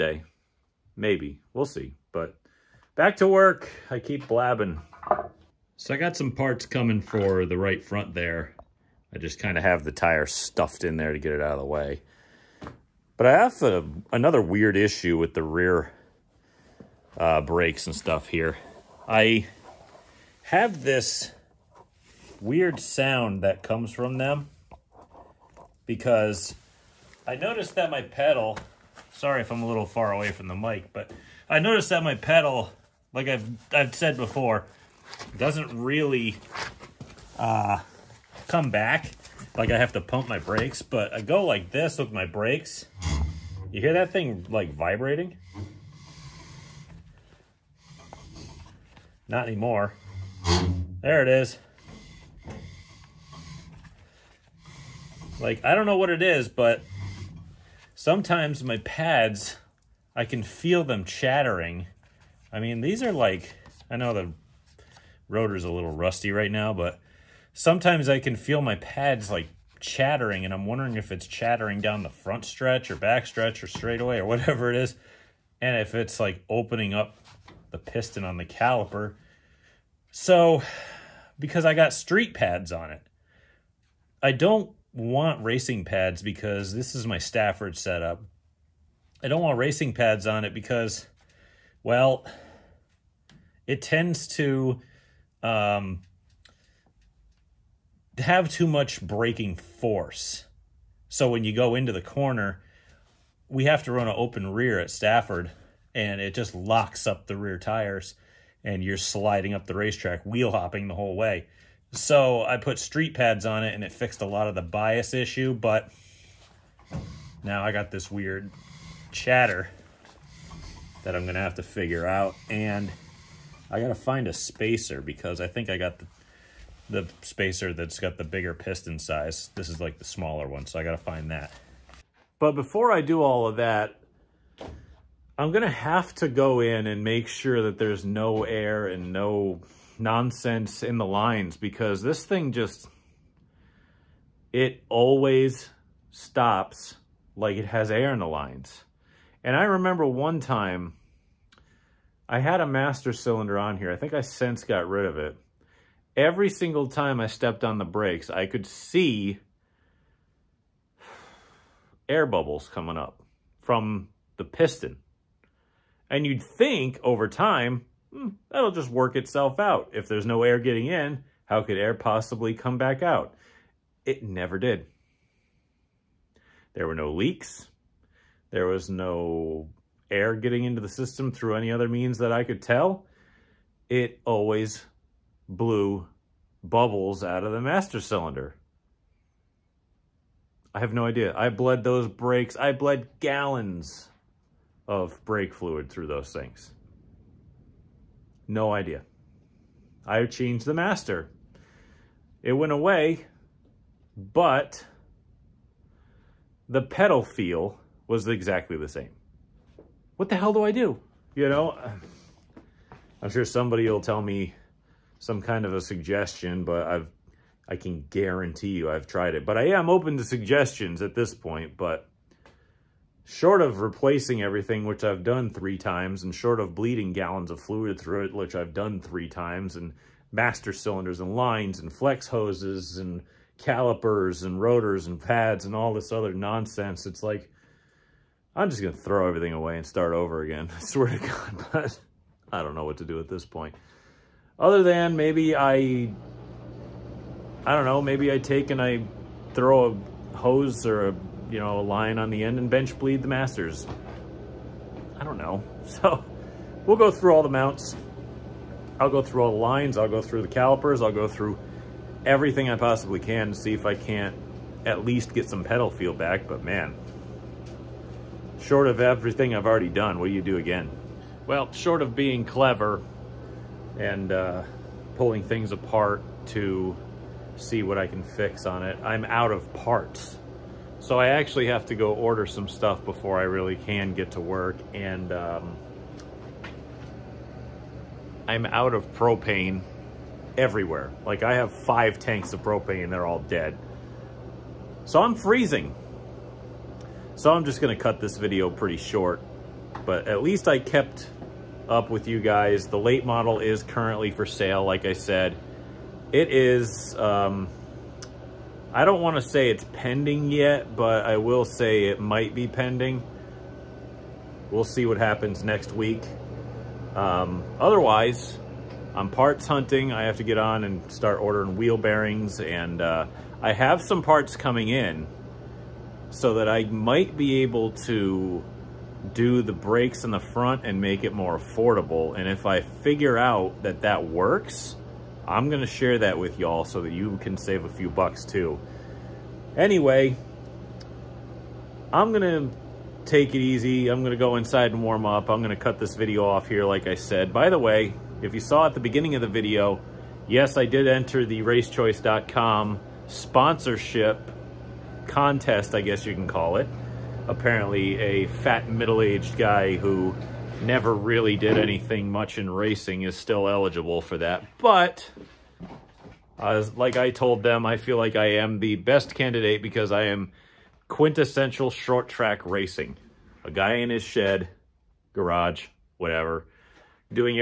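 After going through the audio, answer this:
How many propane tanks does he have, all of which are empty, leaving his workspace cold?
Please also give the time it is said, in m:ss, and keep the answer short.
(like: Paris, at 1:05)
5, at 4:51.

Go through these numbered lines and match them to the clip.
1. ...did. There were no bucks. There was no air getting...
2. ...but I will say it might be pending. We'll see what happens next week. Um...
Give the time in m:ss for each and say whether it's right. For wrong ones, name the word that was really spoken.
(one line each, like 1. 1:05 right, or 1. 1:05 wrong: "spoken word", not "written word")
1. 2:54 wrong: "leaks", not "bucks"
2. 5:10 right.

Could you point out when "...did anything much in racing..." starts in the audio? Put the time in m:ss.
6:01.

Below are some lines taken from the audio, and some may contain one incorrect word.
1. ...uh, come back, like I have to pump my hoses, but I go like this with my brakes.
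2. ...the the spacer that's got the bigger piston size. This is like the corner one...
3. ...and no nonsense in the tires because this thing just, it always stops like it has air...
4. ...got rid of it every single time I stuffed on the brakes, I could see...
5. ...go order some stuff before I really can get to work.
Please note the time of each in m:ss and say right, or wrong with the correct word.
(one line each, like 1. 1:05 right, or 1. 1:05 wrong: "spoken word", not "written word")
1. 0:37 wrong: "brakes", not "hoses"
2. 2:05 wrong: "smaller", not "corner"
3. 2:18 wrong: "lines", not "tires"
4. 2:34 wrong: "stepped", not "stuffed"
5. 4:41 right.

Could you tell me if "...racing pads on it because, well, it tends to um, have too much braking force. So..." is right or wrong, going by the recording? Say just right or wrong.
right.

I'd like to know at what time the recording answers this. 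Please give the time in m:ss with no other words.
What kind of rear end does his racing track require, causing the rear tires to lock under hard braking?
1:44.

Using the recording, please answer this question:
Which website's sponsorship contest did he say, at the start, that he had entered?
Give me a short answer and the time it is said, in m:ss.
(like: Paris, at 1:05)
racechoice.com, at 5:51.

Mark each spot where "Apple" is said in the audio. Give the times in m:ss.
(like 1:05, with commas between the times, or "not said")
not said.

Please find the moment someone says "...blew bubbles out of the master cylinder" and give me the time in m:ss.
3:05.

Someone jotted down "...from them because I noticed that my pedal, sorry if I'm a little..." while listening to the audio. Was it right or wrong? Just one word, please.
right.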